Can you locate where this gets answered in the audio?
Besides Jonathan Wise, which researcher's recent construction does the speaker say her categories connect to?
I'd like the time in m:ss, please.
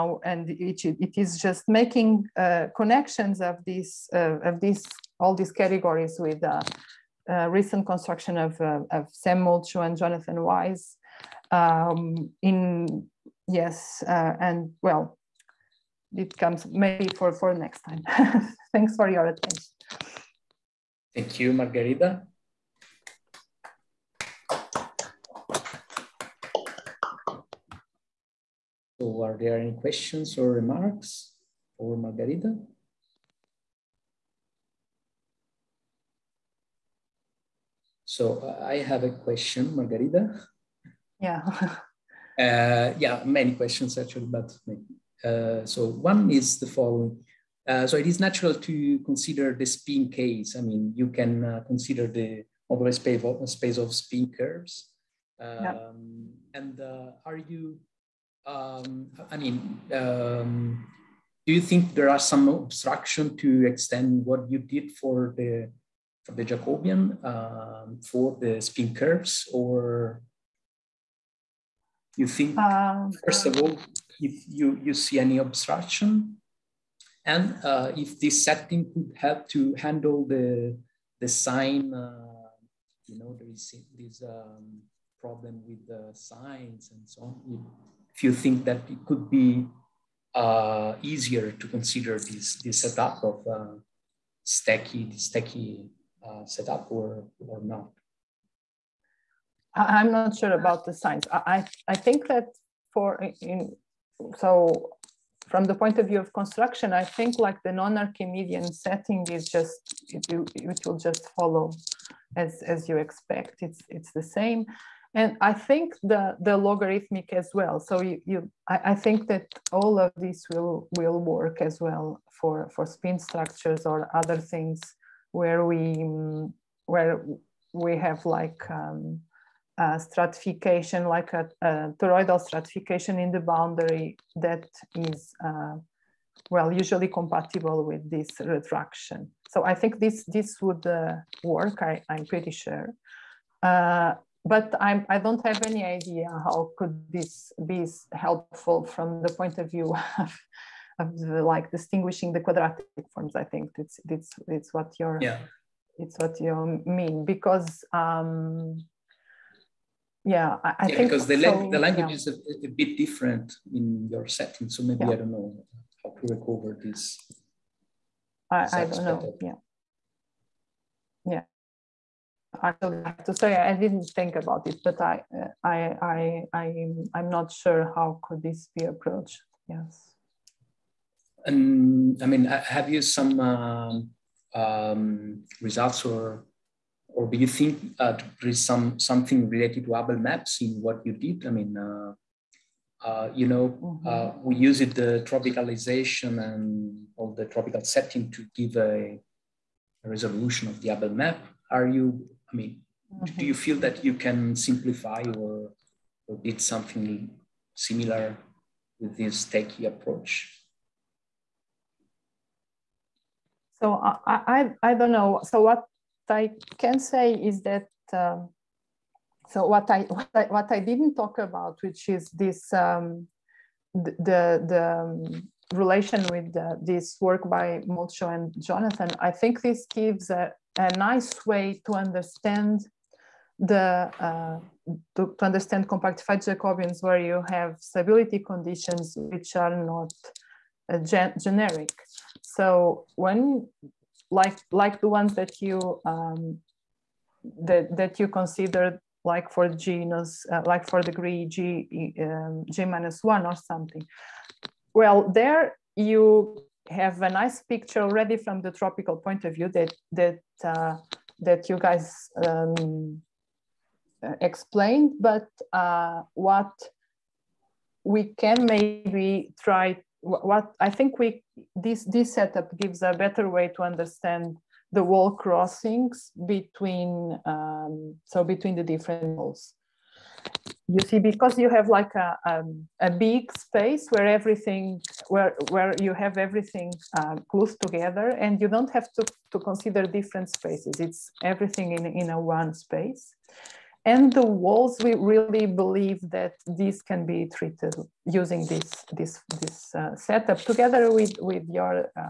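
0:09.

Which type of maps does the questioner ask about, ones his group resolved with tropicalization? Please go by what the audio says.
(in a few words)
Abel maps.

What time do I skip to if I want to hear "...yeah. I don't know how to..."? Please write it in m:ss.
2:45.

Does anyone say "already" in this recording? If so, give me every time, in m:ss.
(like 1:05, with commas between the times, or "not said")
4:18.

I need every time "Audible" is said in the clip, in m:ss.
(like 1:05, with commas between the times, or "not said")
not said.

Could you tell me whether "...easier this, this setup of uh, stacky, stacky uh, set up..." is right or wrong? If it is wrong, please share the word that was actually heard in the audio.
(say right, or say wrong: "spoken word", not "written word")
wrong: "consider", not "easier".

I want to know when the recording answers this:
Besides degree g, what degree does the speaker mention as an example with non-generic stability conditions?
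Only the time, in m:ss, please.
4:12.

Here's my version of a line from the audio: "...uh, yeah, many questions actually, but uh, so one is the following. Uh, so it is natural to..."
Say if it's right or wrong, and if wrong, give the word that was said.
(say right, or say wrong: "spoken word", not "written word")
right.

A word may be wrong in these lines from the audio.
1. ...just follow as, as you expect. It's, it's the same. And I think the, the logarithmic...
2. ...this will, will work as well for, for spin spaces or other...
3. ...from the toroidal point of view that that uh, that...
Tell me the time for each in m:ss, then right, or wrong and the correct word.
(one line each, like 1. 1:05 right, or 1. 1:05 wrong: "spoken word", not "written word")
1. 1:50 right
2. 2:00 wrong: "structures", not "spaces"
3. 4:18 wrong: "tropical", not "toroidal".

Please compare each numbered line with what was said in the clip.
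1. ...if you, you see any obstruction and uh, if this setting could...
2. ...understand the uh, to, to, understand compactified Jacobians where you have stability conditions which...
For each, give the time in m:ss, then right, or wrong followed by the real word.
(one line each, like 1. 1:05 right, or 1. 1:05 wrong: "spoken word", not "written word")
1. 1:14 right
2. 3:51 right.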